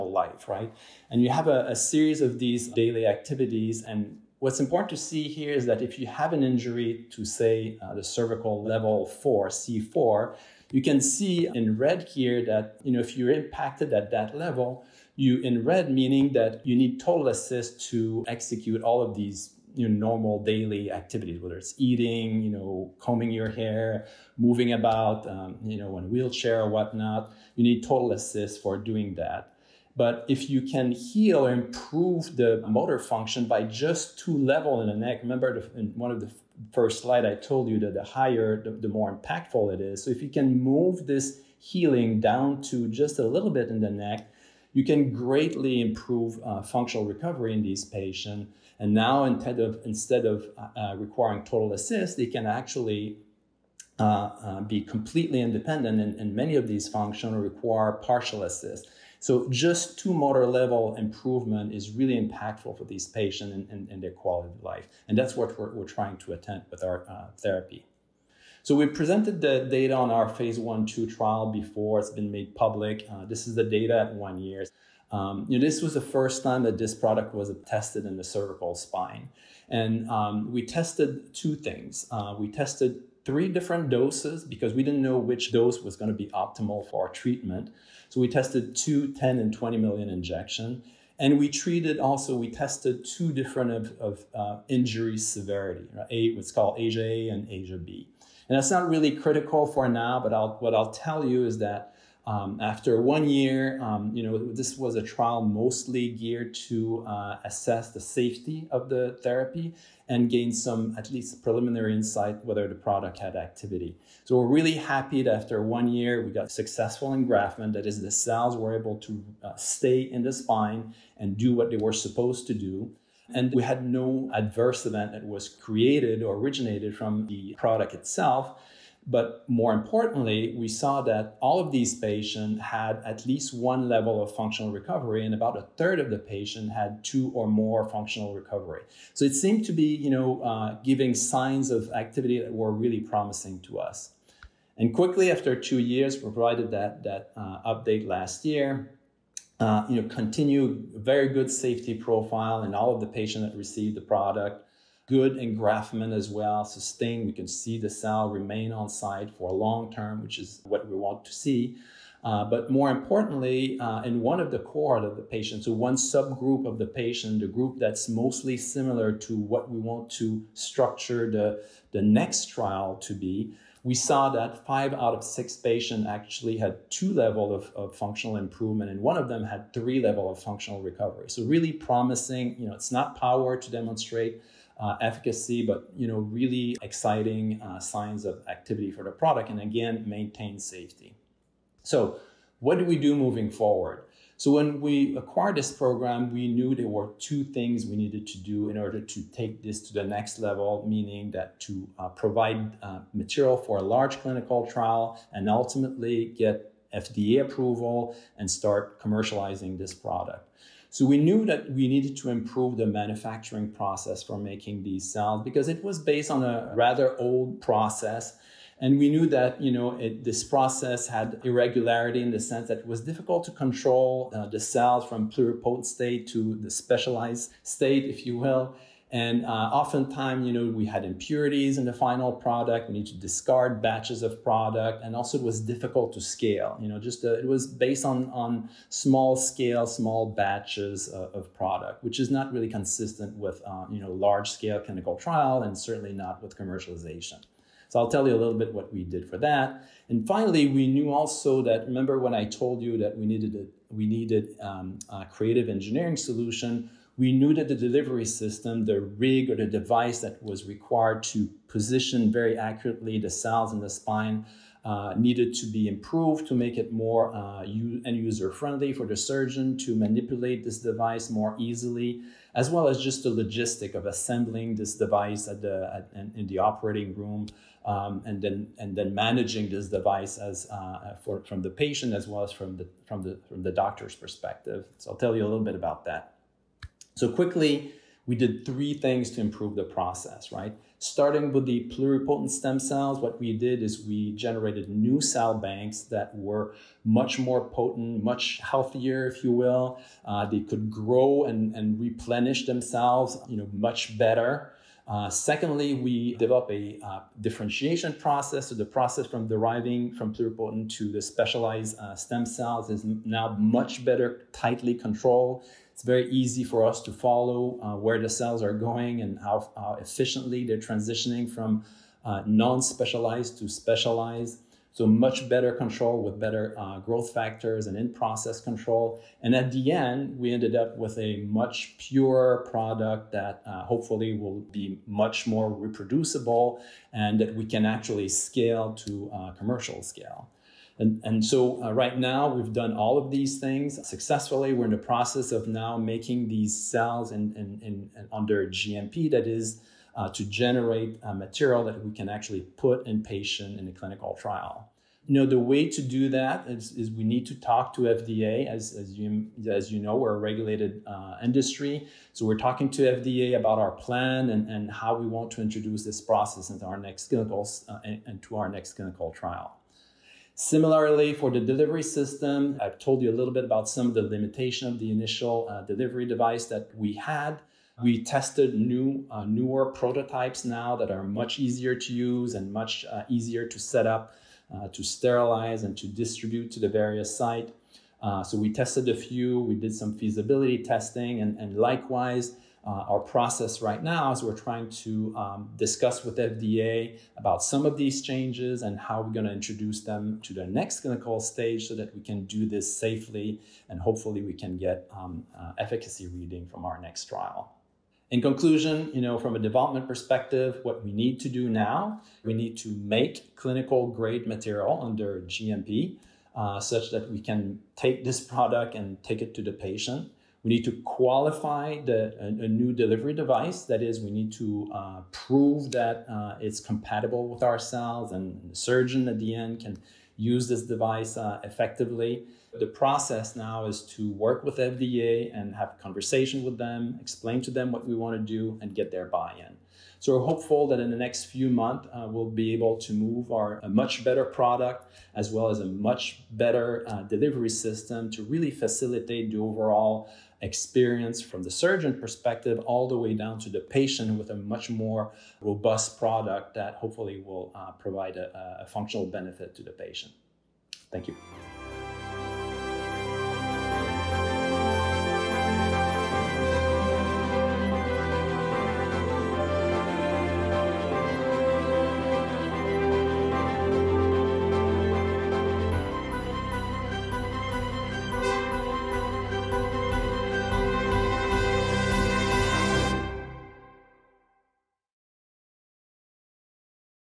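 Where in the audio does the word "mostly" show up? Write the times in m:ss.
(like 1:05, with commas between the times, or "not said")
1:45, 2:48.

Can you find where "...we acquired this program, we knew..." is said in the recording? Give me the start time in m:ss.
3:14.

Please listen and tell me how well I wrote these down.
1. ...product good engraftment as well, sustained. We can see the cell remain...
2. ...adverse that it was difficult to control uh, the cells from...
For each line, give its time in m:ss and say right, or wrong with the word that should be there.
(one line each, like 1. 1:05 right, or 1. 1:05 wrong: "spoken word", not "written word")
1. 2:34 right
2. 3:42 wrong: "sense", not "adverse".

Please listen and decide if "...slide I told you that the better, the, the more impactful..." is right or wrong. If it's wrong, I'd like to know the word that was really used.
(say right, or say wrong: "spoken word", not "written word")
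wrong: "higher", not "better".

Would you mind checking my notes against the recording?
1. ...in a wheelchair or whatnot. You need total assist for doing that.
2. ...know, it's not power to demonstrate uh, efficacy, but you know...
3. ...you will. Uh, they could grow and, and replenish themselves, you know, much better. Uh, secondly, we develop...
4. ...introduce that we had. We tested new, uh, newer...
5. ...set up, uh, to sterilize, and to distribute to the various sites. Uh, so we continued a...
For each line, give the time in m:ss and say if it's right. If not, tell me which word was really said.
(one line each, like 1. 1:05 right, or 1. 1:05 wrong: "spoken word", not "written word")
1. 0:25 right
2. 3:02 right
3. 4:59 right
4. 6:16 wrong: "device", not "introduce"
5. 6:23 wrong: "tested", not "continued".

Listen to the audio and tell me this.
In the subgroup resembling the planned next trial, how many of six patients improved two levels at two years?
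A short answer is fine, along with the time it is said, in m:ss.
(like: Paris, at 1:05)
5, at 2:54.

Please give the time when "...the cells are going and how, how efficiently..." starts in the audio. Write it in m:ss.
5:18.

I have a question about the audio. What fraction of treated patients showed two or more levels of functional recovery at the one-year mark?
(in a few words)
About a third.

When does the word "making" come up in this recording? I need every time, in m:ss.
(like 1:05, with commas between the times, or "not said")
3:34, 5:45.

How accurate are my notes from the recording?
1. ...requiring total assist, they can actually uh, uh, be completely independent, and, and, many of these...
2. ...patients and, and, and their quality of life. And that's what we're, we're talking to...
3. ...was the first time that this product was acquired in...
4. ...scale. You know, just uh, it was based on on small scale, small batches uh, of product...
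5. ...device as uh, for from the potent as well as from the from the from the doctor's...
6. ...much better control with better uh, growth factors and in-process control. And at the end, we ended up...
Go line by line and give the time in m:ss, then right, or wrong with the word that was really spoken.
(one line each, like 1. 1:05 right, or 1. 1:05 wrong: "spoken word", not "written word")
1. 0:50 right
2. 1:03 wrong: "trying", not "talking"
3. 1:15 wrong: "tested", not "acquired"
4. 3:56 right
5. 4:39 wrong: "patient", not "potent"
6. 5:25 right.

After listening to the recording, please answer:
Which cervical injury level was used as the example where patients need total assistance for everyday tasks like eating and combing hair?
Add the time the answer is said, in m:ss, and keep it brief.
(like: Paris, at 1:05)
C4, at 0:09.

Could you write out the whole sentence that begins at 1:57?
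That is, the cells were able to uh, stay in the spine and do what they were supposed to do.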